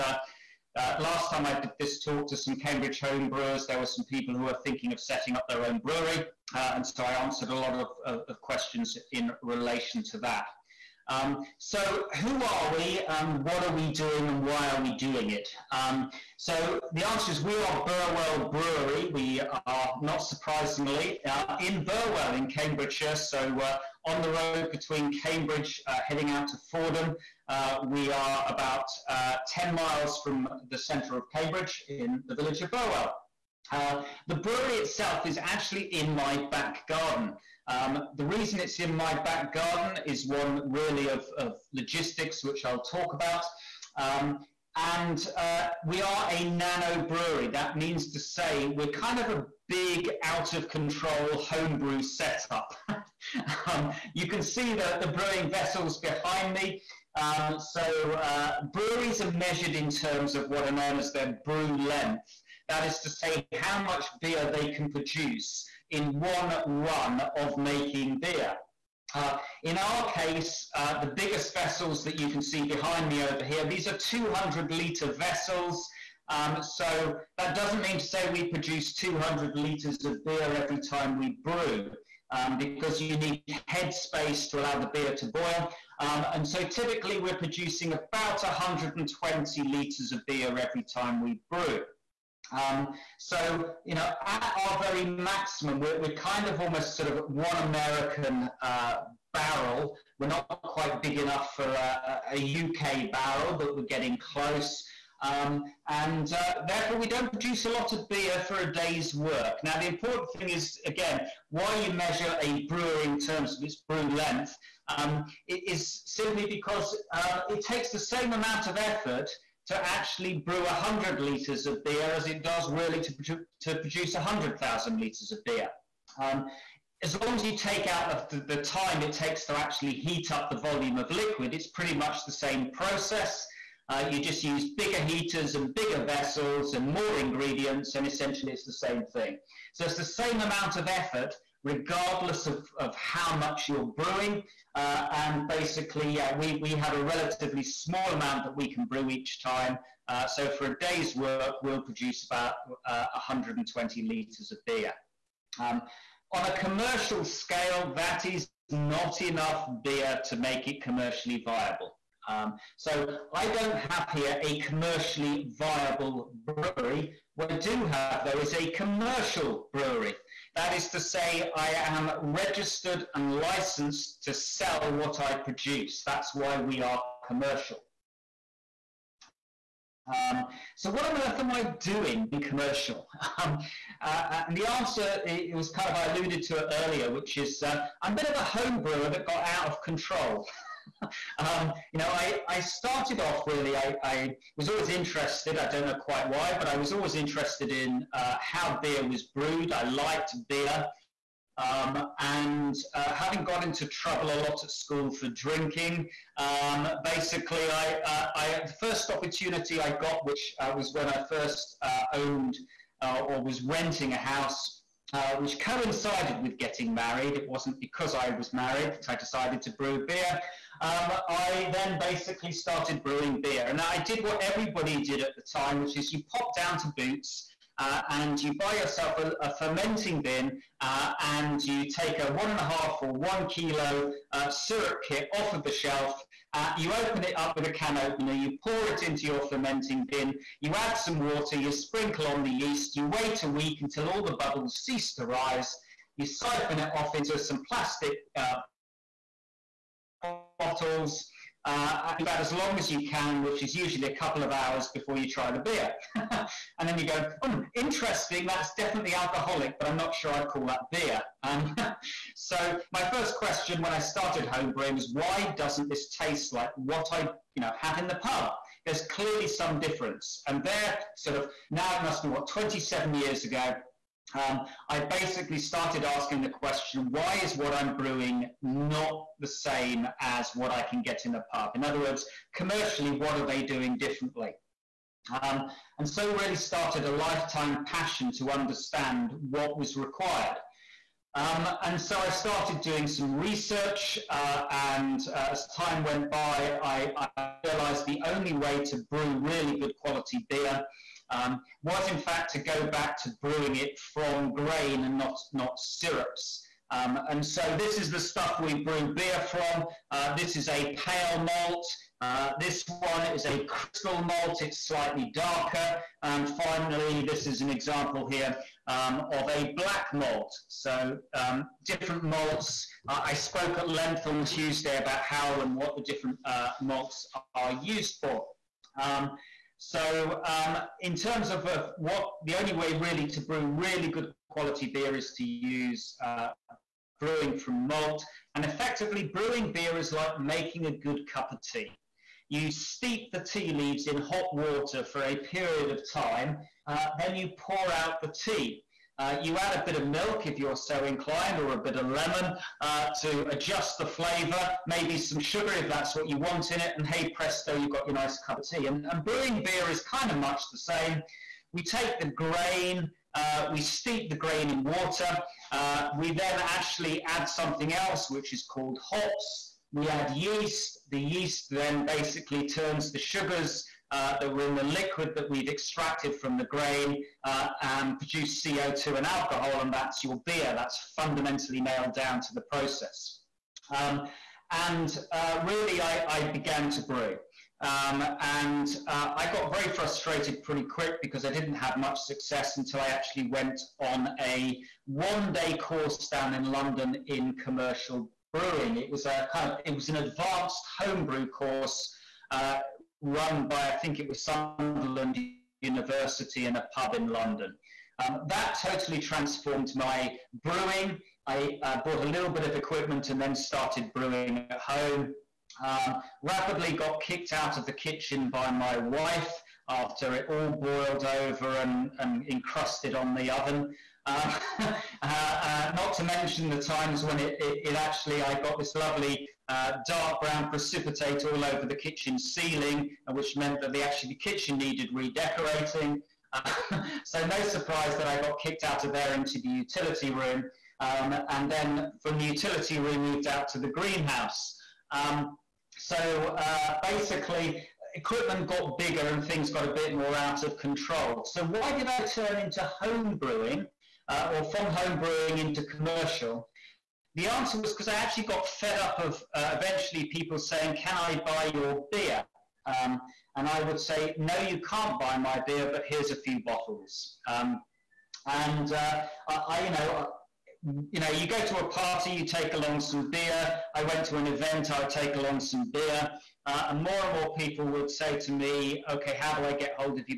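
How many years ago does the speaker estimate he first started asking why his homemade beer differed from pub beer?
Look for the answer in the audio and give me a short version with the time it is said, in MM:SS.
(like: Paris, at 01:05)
27 years, at 04:32.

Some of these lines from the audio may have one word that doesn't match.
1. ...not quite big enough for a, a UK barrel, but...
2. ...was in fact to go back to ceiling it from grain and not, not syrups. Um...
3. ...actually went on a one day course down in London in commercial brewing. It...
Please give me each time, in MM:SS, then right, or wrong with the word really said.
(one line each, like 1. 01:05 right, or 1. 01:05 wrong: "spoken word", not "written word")
1. 01:40 right
2. 05:01 wrong: "brewing", not "ceiling"
3. 06:33 right.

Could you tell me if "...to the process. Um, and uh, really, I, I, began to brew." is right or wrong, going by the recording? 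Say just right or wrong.
right.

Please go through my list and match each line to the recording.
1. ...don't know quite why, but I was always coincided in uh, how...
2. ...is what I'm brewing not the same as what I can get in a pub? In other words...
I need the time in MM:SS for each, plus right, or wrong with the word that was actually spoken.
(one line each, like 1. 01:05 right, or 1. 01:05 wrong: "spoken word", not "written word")
1. 03:15 wrong: "interested", not "coincided"
2. 04:37 right.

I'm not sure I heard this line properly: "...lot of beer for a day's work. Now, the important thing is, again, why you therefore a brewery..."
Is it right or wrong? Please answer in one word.
wrong.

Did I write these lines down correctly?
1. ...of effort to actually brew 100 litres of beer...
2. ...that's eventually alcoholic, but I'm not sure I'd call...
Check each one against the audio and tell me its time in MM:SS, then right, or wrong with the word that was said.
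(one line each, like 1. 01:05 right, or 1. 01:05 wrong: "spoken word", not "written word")
1. 01:58 right
2. 04:18 wrong: "definitely", not "eventually".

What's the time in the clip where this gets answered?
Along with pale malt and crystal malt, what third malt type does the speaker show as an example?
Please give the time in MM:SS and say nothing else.
05:19.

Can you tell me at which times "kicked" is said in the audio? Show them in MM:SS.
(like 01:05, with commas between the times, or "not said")
06:57, 07:18.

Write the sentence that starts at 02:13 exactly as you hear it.
Uh, you just use bigger heaters and bigger vessels and more ingredients, and essentially it's the same thing.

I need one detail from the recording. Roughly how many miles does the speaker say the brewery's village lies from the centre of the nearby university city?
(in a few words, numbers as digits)
10 miles.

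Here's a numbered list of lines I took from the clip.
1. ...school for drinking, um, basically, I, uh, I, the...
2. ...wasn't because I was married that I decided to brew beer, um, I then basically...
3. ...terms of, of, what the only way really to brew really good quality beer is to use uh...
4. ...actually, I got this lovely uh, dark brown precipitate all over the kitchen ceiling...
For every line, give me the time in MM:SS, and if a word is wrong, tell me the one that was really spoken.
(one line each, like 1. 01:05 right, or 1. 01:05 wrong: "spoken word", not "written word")
1. 03:24 right
2. 03:37 right
3. 05:31 right
4. 07:07 right.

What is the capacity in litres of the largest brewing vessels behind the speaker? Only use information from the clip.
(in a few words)
200 litres.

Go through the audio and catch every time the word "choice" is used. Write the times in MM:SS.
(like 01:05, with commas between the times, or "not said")
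not said.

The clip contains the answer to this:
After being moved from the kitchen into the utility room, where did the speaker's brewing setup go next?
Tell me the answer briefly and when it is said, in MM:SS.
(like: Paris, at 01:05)
the greenhouse, at 07:23.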